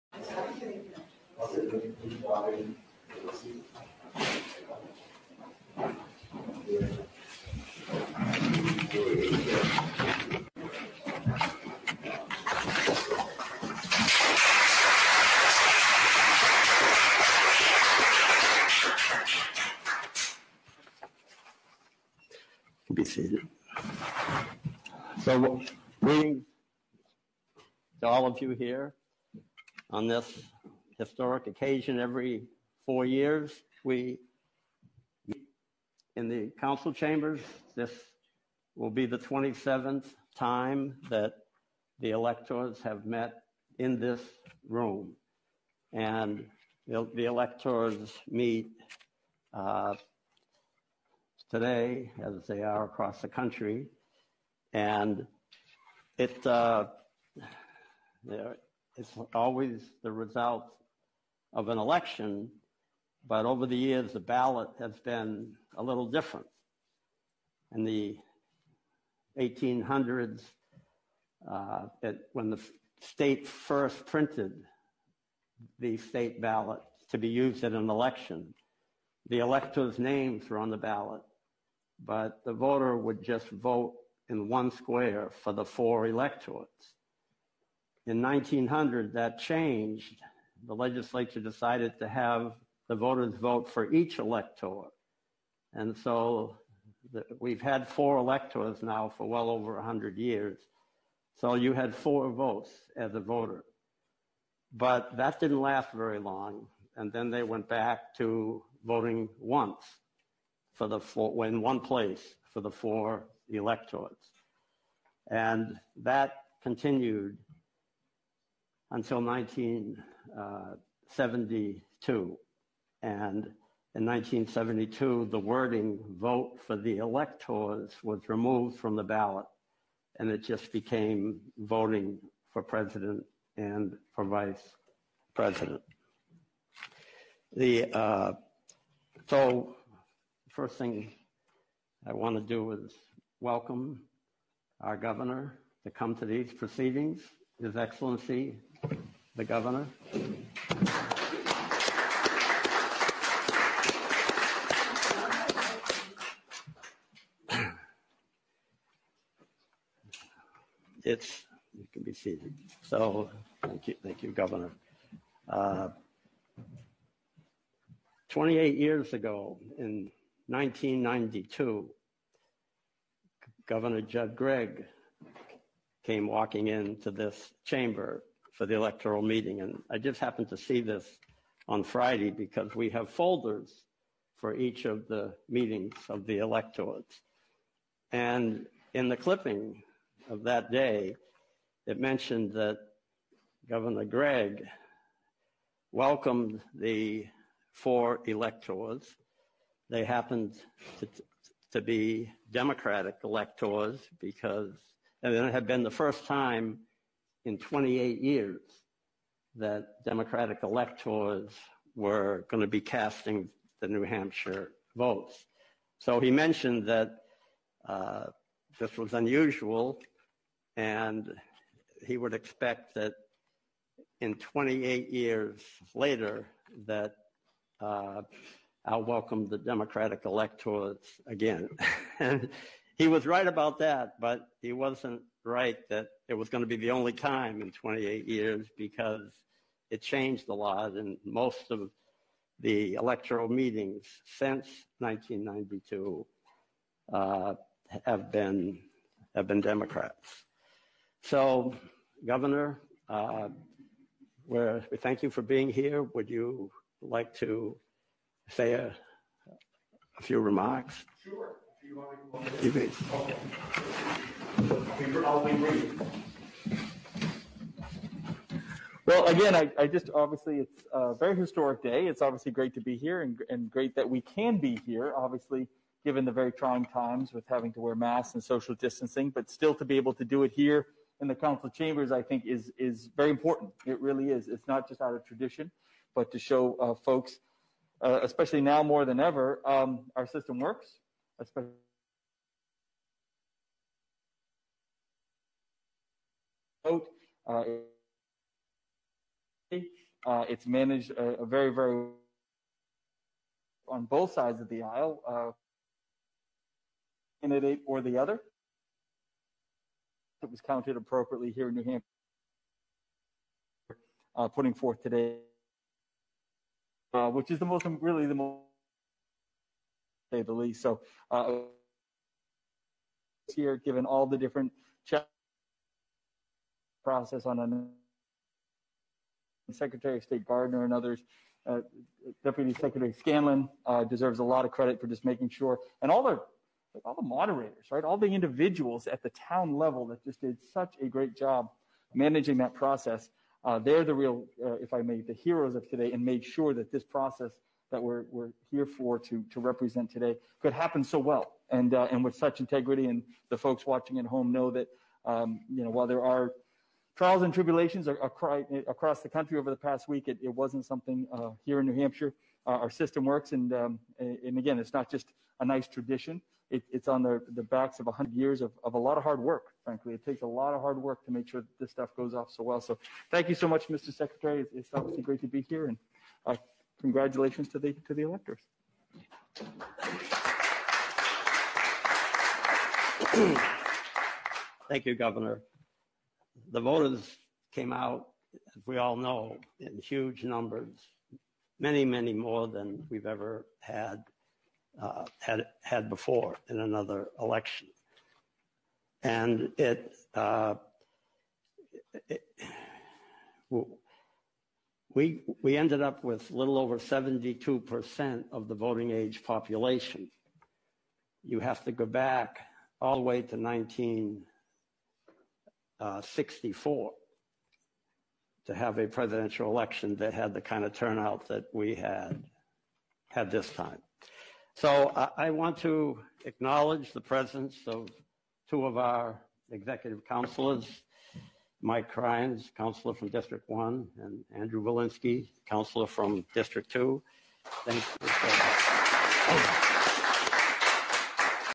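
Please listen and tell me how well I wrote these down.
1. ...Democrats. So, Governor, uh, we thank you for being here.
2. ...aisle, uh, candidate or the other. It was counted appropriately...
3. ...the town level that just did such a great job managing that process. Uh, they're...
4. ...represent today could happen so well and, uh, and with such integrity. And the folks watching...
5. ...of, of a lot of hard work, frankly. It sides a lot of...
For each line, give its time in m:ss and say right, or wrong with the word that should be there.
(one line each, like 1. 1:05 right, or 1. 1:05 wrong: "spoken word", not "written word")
1. 4:09 right
2. 5:04 right
3. 5:39 right
4. 5:49 right
5. 6:08 wrong: "takes", not "sides".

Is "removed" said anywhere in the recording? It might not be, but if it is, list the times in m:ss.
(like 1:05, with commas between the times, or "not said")
2:08.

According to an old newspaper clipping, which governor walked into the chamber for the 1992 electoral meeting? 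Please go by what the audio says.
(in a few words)
Judd Gregg.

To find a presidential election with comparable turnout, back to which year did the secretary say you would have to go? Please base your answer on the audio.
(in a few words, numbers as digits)
1964.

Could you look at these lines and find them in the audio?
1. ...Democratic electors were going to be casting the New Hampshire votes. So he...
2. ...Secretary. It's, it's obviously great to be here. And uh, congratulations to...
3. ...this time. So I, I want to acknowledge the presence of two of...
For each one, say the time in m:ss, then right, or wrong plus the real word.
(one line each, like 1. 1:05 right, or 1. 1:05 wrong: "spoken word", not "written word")
1. 3:30 right
2. 6:14 right
3. 7:03 right.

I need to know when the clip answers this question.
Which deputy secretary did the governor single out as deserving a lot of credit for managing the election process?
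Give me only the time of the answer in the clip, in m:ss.
5:33.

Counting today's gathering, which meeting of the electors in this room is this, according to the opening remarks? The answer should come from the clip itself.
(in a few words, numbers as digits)
27th.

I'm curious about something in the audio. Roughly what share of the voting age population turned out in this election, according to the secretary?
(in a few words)
72%.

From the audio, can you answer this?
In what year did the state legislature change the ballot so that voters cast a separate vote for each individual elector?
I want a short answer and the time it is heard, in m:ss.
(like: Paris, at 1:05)
1900, at 1:28.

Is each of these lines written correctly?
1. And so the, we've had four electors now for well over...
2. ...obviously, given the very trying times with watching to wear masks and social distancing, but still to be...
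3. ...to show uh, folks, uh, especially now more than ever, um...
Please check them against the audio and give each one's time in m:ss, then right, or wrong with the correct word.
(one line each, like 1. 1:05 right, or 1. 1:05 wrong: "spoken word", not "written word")
1. 1:35 right
2. 4:35 wrong: "having", not "watching"
3. 4:46 right.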